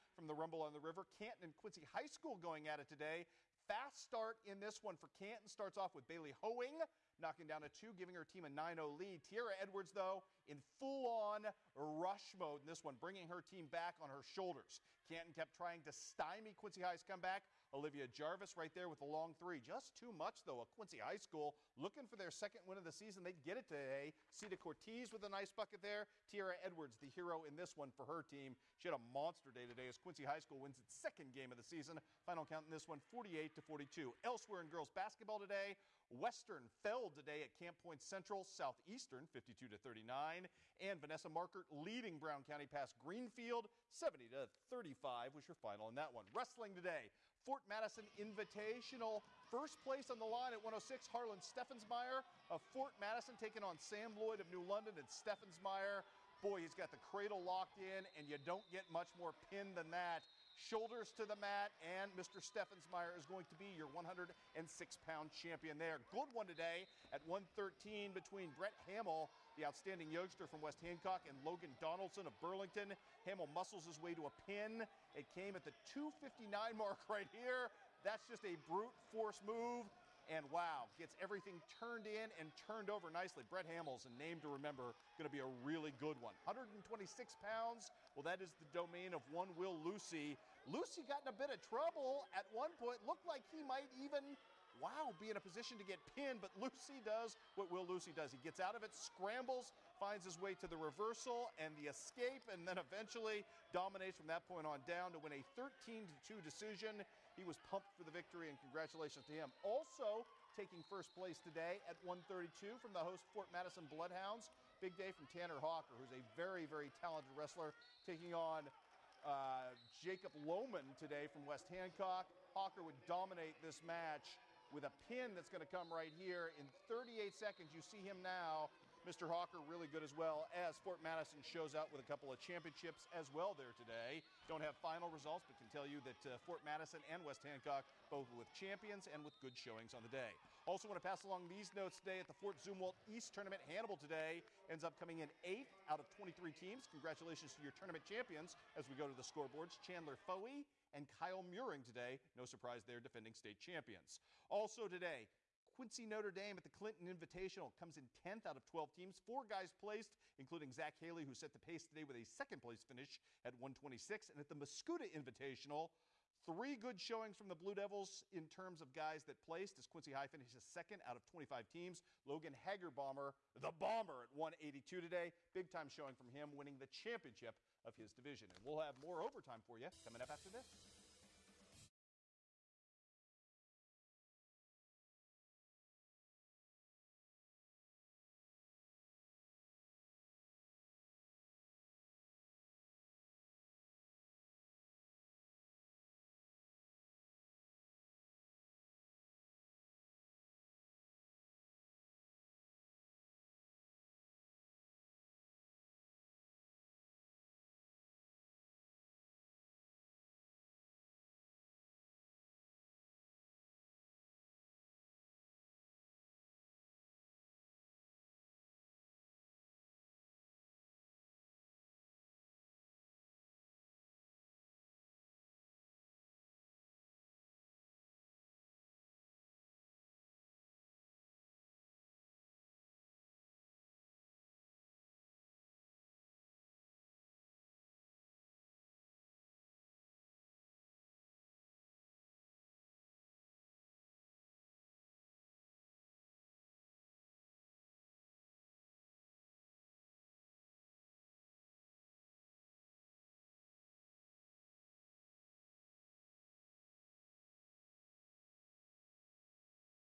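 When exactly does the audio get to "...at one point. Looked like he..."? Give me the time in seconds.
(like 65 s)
92 s.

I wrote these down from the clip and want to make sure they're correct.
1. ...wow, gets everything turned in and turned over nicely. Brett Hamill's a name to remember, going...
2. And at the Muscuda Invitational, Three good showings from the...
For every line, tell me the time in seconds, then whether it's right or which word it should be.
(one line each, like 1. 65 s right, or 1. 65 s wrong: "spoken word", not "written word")
1. 80 s right
2. 164 s right.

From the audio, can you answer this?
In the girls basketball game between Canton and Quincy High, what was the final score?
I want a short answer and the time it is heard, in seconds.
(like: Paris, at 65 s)
48-42, at 33 s.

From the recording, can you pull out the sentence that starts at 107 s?
He was pumped for the victory, and congratulations to him.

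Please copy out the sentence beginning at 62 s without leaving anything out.
Steffensmeyer is going to be your 106 pound champion there.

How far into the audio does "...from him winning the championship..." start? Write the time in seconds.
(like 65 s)
176 s.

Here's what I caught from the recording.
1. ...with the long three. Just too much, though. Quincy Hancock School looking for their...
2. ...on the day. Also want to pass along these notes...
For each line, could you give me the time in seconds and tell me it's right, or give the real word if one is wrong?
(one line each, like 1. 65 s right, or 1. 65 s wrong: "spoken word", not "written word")
1. 18 s wrong: "High", not "Hancock"
2. 139 s right.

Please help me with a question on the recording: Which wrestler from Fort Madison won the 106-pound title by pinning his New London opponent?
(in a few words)
Harlan Steffensmeyer.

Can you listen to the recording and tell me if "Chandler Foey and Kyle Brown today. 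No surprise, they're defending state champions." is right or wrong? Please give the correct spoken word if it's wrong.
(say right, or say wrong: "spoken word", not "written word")
wrong: "Muring", not "Brown".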